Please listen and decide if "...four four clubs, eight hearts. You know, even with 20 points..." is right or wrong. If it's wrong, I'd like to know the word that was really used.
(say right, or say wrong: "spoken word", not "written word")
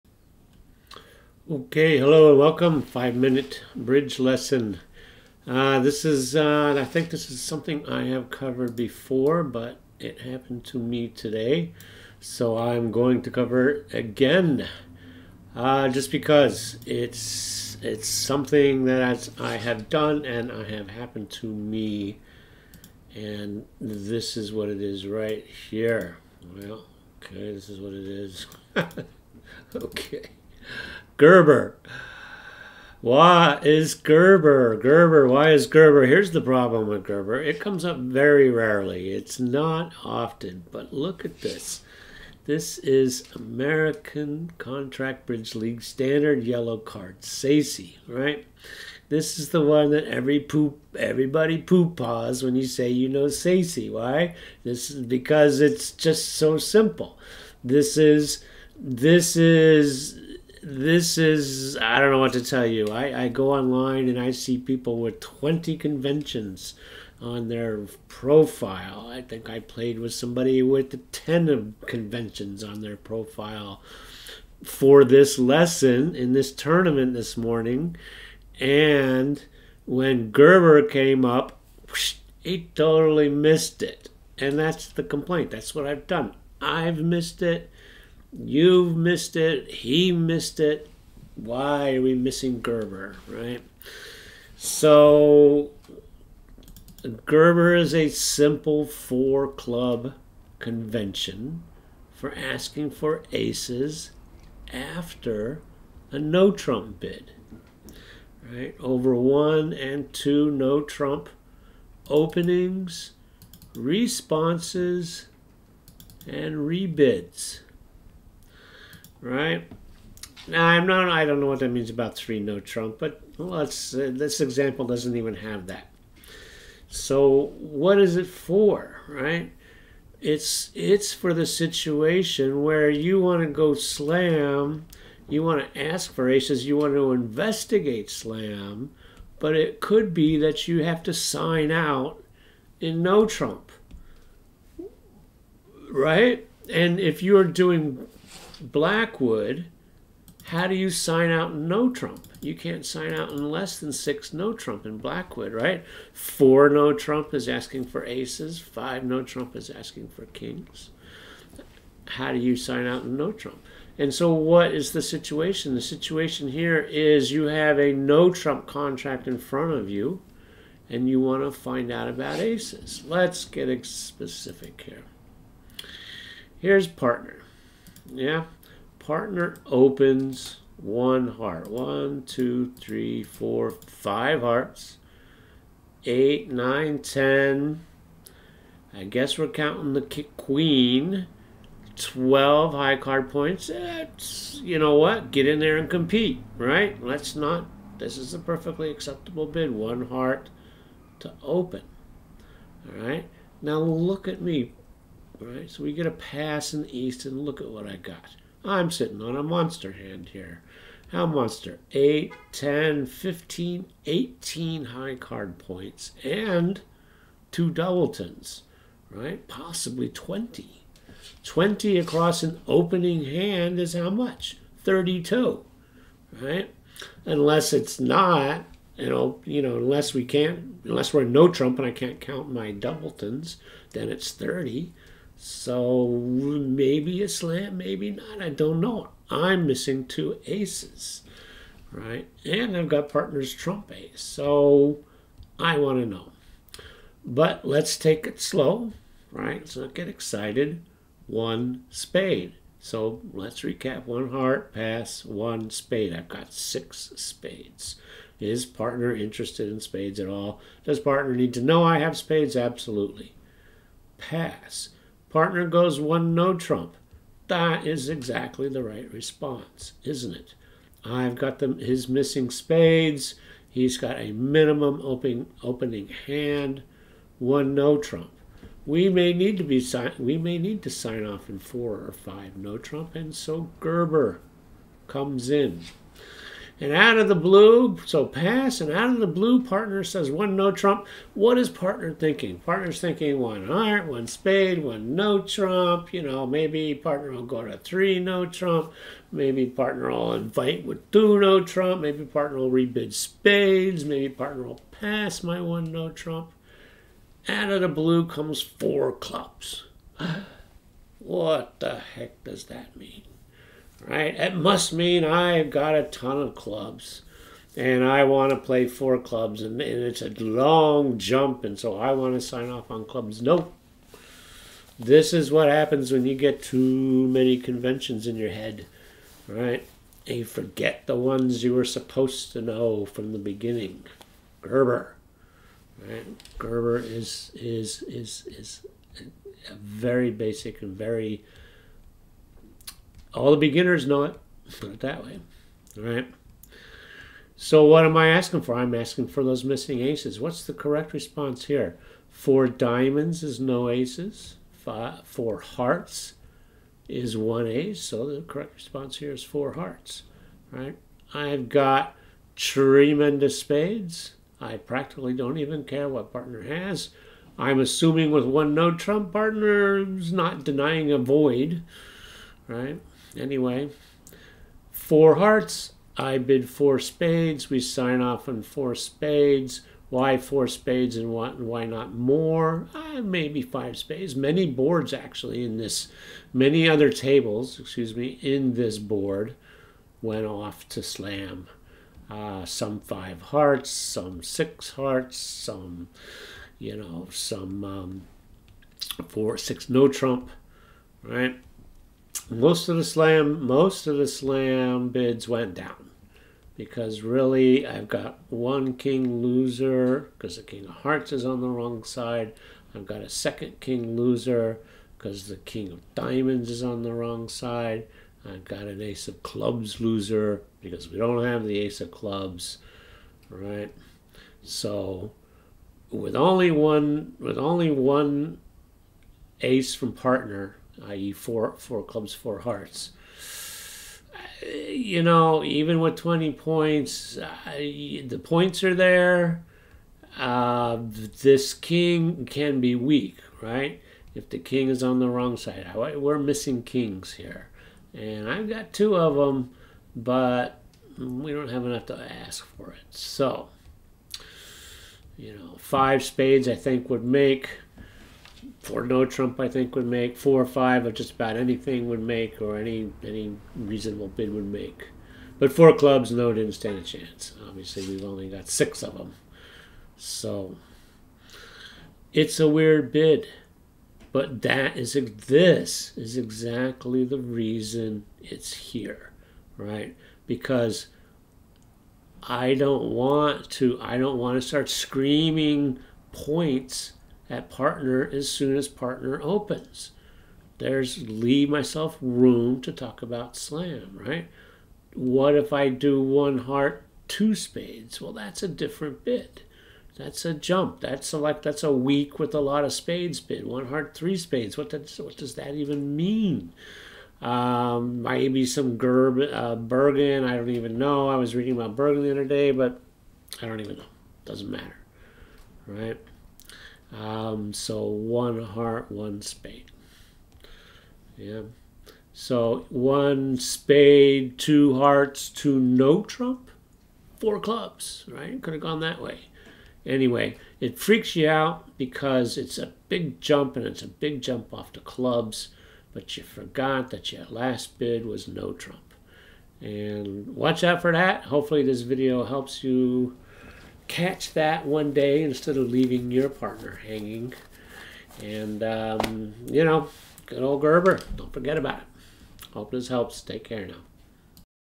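wrong: "four", not "eight".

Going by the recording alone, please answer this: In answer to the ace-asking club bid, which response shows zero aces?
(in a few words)
Four diamonds.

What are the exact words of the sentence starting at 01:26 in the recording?
I've missed it You've missed it.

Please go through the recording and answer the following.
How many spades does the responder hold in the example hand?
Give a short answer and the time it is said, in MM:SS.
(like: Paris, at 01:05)
6, at 04:16.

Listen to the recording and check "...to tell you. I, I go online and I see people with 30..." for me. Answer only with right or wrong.
wrong.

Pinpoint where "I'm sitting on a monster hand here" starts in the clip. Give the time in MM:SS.
03:28.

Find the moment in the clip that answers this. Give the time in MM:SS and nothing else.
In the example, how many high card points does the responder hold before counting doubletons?
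03:34.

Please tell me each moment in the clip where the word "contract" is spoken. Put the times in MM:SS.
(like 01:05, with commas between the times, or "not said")
00:44, 02:48.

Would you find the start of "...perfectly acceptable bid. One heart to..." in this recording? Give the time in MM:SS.
03:18.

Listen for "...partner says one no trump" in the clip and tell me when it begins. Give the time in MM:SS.
04:49.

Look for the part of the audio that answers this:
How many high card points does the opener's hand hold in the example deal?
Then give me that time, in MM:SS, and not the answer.
03:11.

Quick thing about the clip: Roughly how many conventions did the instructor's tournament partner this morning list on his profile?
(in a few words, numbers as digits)
10.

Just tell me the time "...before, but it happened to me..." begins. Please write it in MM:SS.
00:08.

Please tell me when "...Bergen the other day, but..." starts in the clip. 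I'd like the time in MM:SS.
08:31.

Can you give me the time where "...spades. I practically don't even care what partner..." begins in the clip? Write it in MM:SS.
06:03.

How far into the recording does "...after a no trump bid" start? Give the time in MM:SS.
01:44.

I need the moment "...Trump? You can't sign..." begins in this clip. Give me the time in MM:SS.
02:31.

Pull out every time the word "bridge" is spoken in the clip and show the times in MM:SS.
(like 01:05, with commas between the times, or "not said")
00:03, 00:45.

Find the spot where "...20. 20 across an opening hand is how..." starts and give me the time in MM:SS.
03:40.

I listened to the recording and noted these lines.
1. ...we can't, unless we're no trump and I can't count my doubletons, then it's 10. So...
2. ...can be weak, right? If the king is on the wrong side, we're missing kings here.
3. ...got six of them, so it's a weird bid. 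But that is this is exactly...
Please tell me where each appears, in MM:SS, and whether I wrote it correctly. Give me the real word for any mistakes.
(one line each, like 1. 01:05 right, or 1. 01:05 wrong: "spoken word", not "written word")
1. 03:50 wrong: "30", not "10"
2. 07:22 right
3. 07:48 right.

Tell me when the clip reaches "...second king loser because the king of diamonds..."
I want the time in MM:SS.
06:53.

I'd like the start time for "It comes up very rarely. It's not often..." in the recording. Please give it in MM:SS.
00:37.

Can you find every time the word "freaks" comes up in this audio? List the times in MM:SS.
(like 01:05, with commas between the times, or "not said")
08:50.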